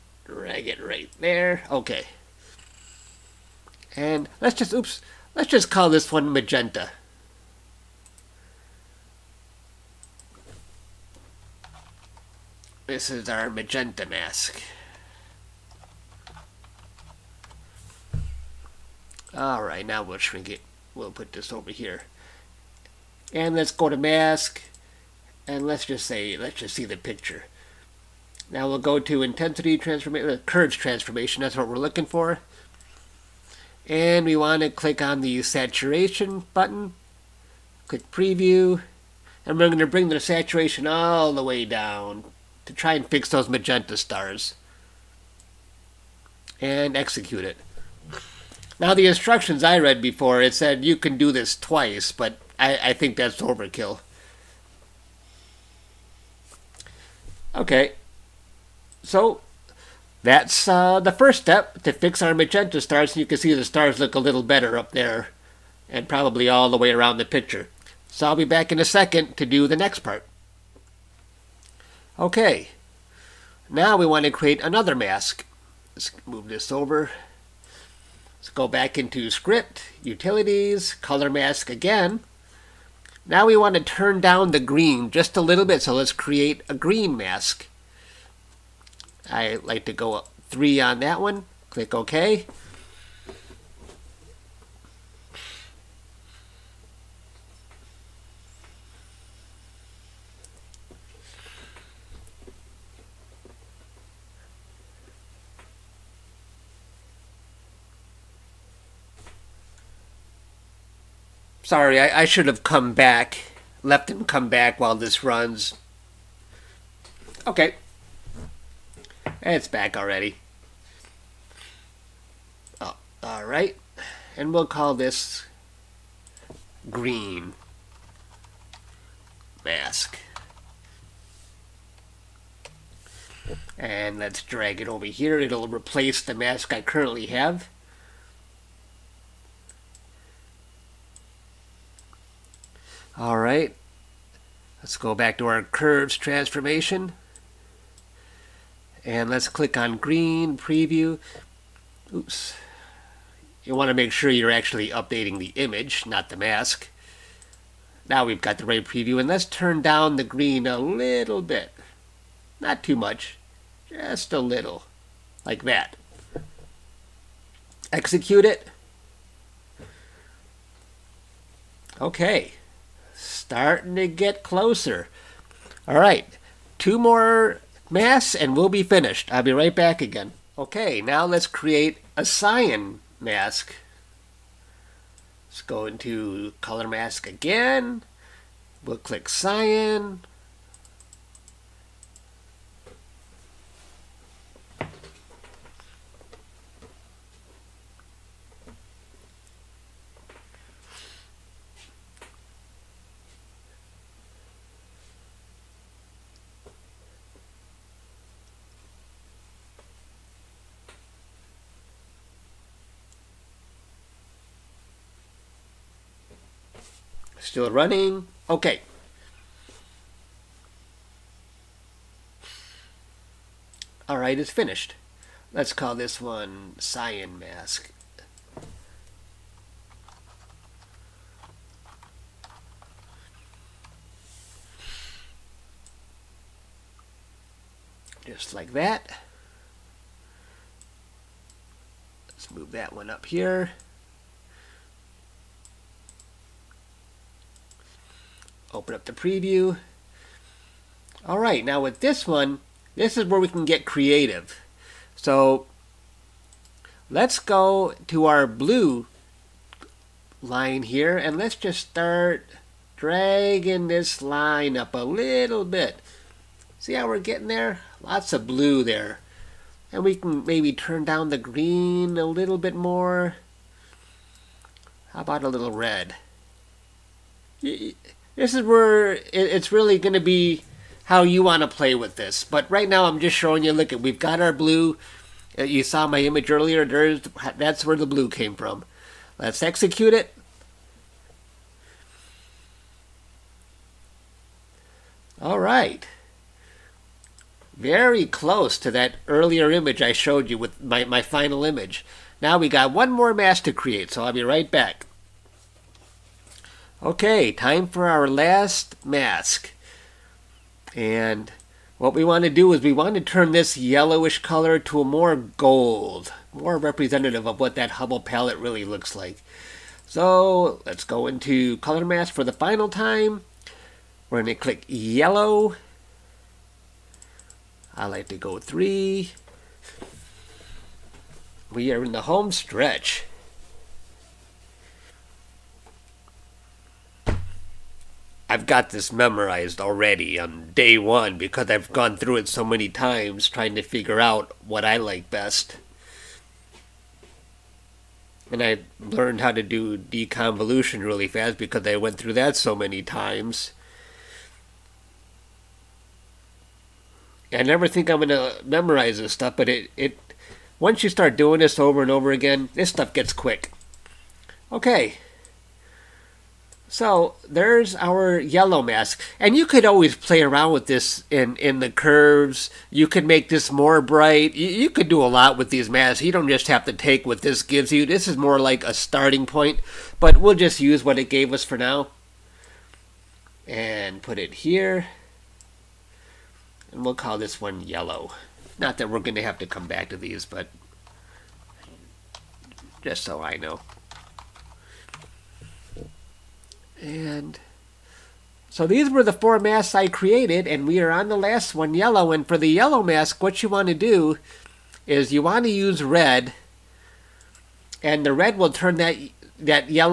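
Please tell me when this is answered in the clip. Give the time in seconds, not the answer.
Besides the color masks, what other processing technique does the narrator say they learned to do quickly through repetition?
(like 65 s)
349 s.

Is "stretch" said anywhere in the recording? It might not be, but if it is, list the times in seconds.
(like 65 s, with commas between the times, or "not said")
332 s.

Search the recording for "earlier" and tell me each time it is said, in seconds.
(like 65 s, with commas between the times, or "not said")
286 s, 299 s.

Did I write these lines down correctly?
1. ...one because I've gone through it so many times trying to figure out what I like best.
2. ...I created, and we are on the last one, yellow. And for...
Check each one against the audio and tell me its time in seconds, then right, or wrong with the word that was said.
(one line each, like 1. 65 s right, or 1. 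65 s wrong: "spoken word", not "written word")
1. 340 s right
2. 399 s right.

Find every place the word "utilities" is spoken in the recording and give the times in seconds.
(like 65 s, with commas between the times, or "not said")
80 s.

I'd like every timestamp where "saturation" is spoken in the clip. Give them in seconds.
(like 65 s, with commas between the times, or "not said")
35 s, 40 s.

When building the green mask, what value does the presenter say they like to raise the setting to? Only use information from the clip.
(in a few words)
3.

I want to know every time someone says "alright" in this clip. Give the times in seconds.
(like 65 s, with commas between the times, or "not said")
19 s, 123 s, 224 s.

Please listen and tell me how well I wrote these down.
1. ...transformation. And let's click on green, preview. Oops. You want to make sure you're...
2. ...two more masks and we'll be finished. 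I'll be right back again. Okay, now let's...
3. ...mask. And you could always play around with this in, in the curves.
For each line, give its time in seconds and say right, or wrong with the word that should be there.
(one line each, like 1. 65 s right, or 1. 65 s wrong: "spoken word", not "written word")
1. 146 s right
2. 176 s right
3. 368 s right.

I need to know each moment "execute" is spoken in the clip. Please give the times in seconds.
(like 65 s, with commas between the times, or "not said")
46 s, 167 s, 289 s.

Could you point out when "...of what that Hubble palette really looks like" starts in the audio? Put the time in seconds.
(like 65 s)
317 s.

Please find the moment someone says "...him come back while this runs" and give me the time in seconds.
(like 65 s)
114 s.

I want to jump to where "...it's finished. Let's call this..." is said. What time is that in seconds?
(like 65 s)
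224 s.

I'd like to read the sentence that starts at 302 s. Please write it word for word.
Now we got one more mask to create, so I'll be right back.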